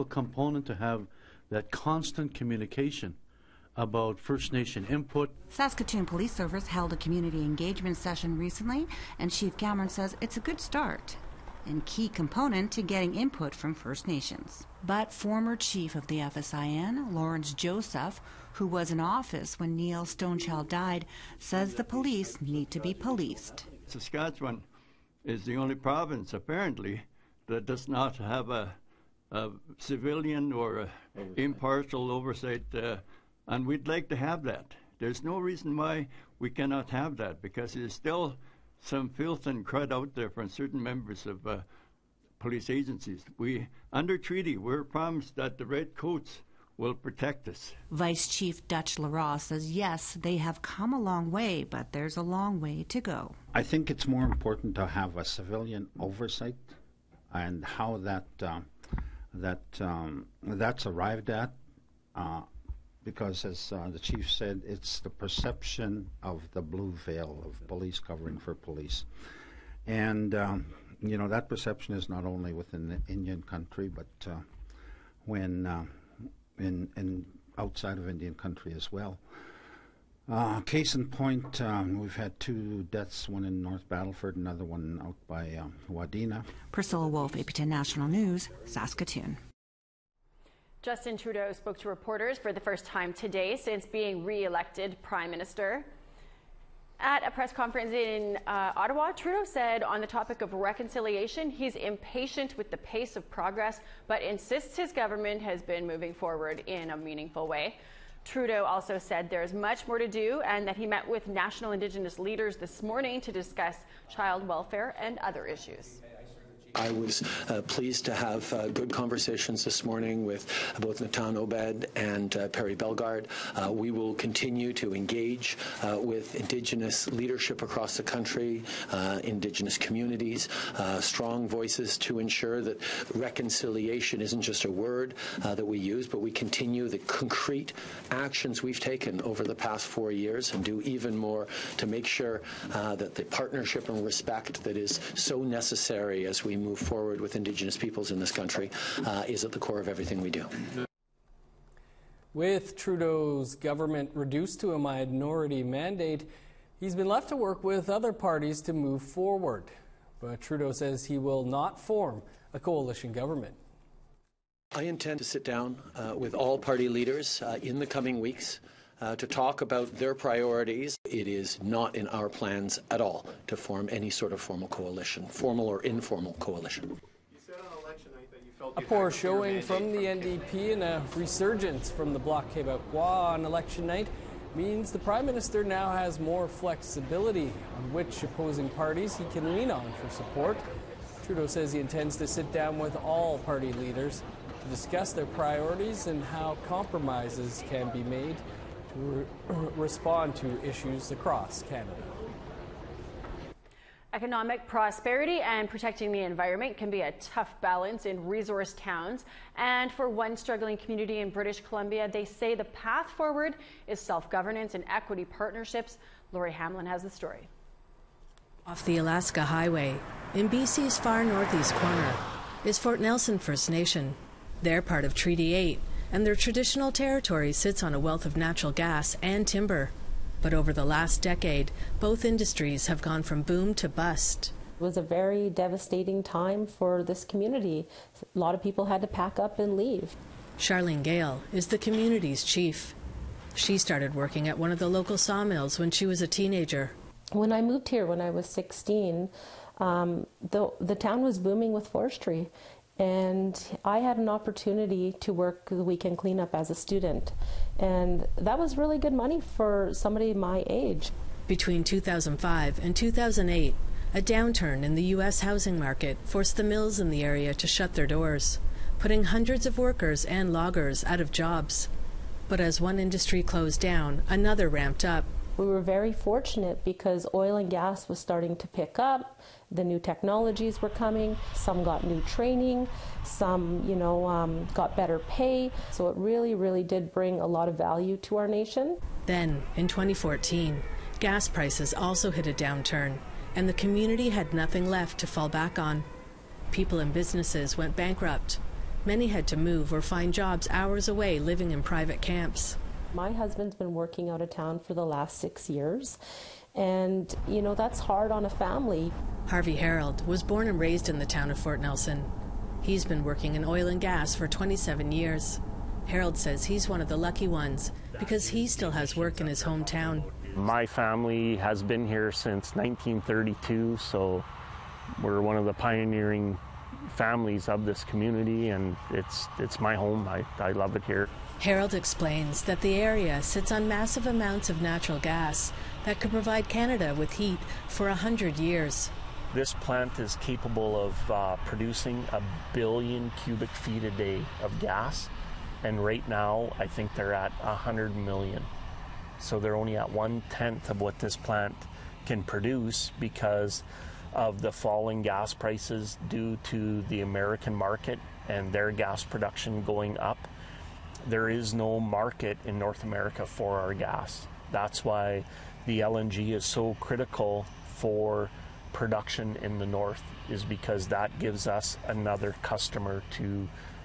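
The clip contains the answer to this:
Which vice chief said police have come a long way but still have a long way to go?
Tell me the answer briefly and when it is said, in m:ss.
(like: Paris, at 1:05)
Dutch Lerat, at 0:48.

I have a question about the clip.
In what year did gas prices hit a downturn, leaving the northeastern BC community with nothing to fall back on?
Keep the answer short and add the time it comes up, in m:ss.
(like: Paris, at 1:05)
2014, at 4:49.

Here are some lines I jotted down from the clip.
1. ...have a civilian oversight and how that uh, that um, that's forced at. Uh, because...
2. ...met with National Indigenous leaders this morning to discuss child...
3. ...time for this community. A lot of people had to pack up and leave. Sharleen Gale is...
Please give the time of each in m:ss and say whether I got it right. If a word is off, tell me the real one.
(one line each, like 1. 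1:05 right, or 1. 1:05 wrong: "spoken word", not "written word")
1. 0:54 wrong: "arrived", not "forced"
2. 1:50 right
3. 3:56 right.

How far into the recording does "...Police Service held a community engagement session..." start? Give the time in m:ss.
0:06.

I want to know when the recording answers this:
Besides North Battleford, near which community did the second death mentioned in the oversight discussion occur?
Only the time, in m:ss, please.
1:25.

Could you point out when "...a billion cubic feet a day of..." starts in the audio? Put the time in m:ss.
5:42.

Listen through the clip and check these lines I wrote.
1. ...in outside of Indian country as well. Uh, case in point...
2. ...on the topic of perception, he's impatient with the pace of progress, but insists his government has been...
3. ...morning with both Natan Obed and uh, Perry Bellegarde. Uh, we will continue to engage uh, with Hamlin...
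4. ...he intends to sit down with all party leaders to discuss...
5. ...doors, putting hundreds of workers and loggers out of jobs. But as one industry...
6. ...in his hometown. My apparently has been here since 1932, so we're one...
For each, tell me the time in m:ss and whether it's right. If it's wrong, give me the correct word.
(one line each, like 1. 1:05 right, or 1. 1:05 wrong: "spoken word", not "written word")
1. 1:16 right
2. 1:39 wrong: "reconciliation", not "perception"
3. 1:59 wrong: "Indigenous", not "Hamlin"
4. 3:11 right
5. 4:28 right
6. 5:19 wrong: "family", not "apparently".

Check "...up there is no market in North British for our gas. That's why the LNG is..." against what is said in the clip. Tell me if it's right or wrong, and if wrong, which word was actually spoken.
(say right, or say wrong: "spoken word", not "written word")
wrong: "America", not "British".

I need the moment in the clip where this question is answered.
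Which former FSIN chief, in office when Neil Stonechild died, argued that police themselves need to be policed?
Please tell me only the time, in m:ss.
0:17.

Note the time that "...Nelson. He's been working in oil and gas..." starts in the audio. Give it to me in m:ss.
5:11.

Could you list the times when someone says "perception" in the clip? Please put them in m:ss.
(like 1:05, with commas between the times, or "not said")
1:05, 1:11.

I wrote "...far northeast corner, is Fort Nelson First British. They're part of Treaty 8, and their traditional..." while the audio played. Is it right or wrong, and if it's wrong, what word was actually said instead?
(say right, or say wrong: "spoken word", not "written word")
wrong: "Nation", not "British".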